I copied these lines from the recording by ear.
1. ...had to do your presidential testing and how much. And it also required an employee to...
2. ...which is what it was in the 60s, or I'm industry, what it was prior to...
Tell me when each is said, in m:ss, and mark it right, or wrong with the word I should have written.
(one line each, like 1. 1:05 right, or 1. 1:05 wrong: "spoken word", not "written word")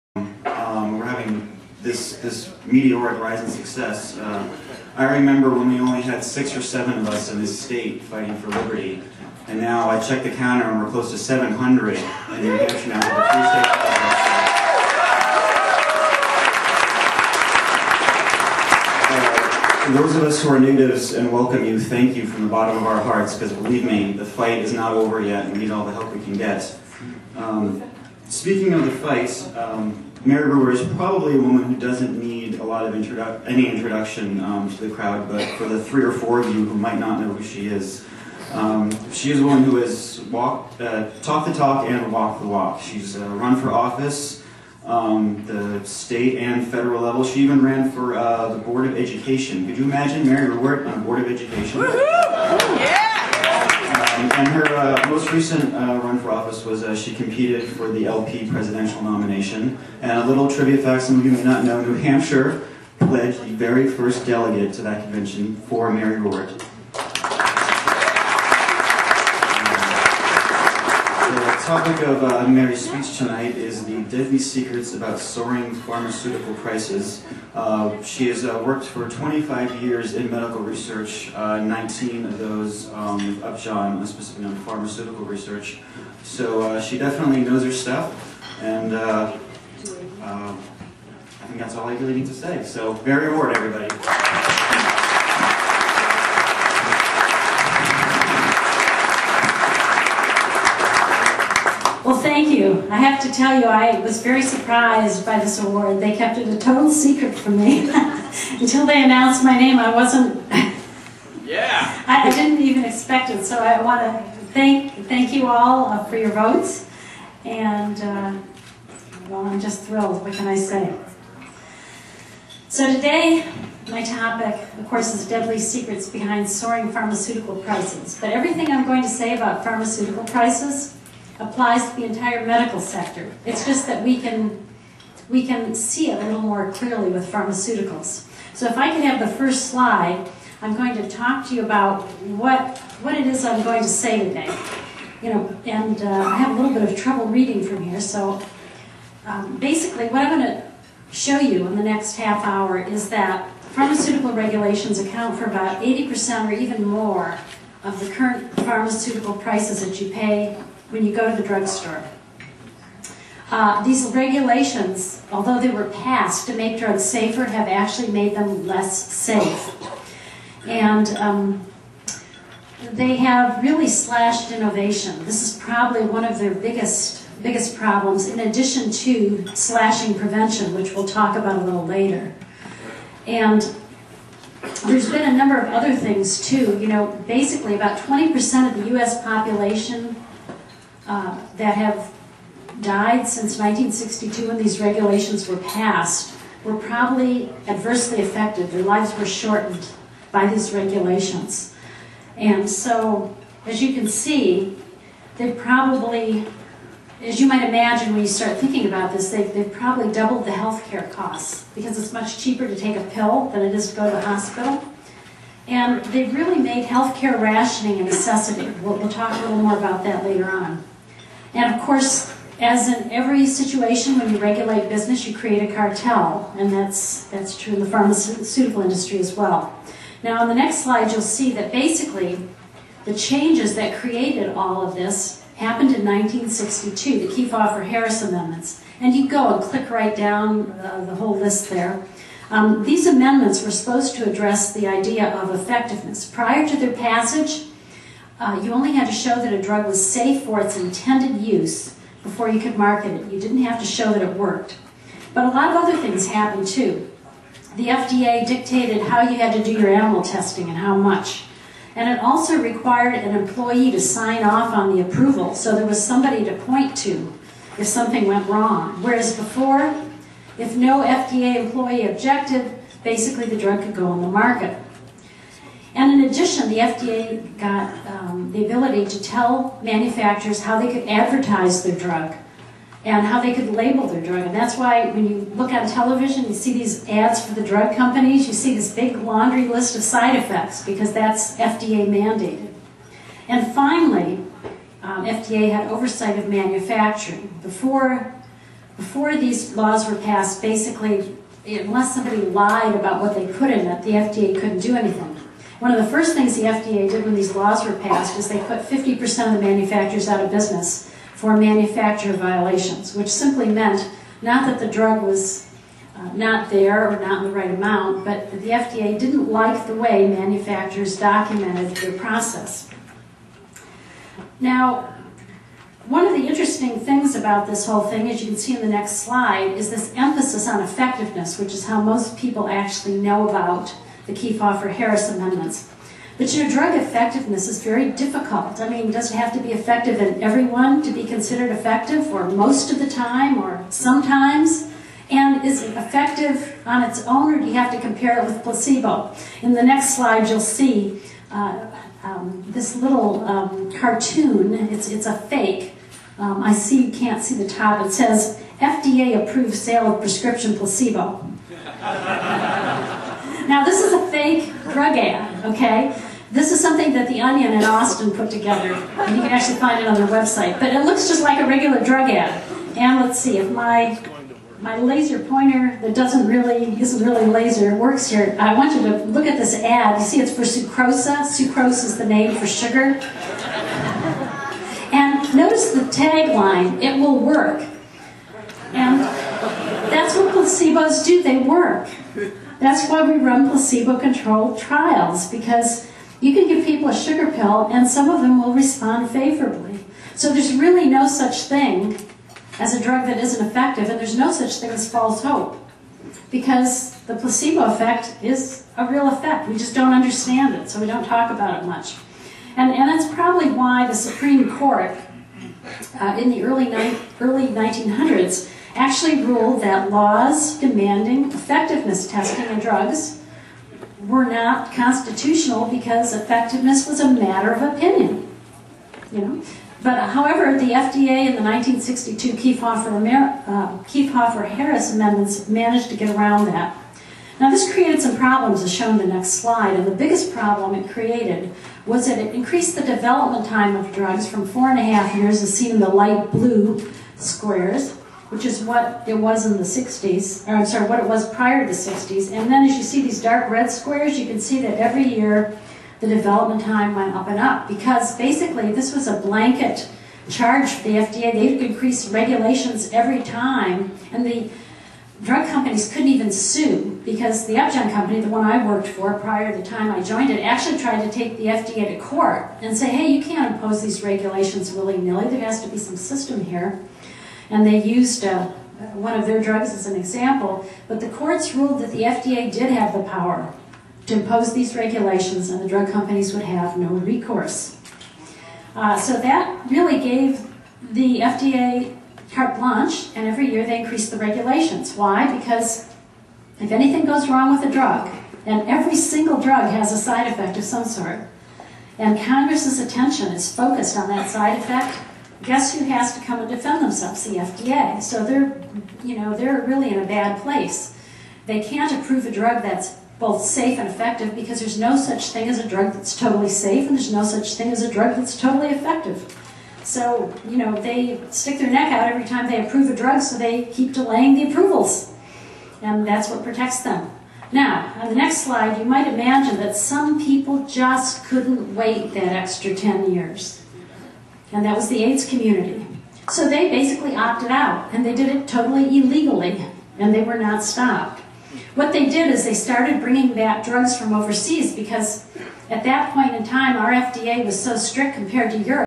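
1. 4:19 wrong: "animal", not "presidential"
2. 7:28 wrong: "sorry", not "industry".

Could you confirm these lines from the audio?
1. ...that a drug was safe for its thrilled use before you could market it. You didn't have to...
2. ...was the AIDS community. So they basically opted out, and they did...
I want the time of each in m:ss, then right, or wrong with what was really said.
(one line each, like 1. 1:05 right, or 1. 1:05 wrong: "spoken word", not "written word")
1. 4:09 wrong: "intended", not "thrilled"
2. 8:54 right.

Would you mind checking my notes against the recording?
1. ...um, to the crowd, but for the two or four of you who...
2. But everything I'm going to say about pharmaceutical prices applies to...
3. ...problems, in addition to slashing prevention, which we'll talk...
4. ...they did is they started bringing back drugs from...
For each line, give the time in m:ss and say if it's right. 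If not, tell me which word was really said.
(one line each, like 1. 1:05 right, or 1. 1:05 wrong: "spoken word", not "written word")
1. 0:34 wrong: "three", not "two"
2. 2:08 right
3. 2:57 right
4. 9:02 right.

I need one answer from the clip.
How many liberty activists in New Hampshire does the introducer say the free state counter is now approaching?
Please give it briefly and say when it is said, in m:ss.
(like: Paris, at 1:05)
700, at 0:11.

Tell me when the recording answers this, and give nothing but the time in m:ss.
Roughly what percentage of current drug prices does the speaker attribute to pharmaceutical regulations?
2:35.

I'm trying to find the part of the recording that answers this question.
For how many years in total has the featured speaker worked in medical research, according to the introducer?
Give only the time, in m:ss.
1:19.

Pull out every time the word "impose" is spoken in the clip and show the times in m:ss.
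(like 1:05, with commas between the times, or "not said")
7:53, 8:04.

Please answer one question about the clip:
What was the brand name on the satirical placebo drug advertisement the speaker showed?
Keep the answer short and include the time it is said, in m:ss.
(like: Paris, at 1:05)
sucrosa, at 6:20.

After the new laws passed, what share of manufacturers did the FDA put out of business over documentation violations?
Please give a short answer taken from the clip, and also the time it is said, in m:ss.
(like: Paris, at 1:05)
50%, at 5:08.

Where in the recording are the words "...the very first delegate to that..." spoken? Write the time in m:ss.
1:03.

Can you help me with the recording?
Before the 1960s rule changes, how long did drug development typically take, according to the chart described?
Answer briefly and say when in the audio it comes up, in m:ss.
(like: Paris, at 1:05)
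4.5 years, at 7:24.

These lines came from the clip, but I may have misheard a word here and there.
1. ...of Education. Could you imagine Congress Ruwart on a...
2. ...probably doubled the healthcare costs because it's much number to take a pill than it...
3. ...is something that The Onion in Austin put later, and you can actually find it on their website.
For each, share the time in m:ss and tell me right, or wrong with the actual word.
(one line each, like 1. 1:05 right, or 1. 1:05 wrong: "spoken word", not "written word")
1. 0:48 wrong: "Mary", not "Congress"
2. 3:29 wrong: "cheaper", not "number"
3. 6:06 wrong: "together", not "later".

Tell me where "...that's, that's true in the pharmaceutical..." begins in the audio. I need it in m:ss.
3:46.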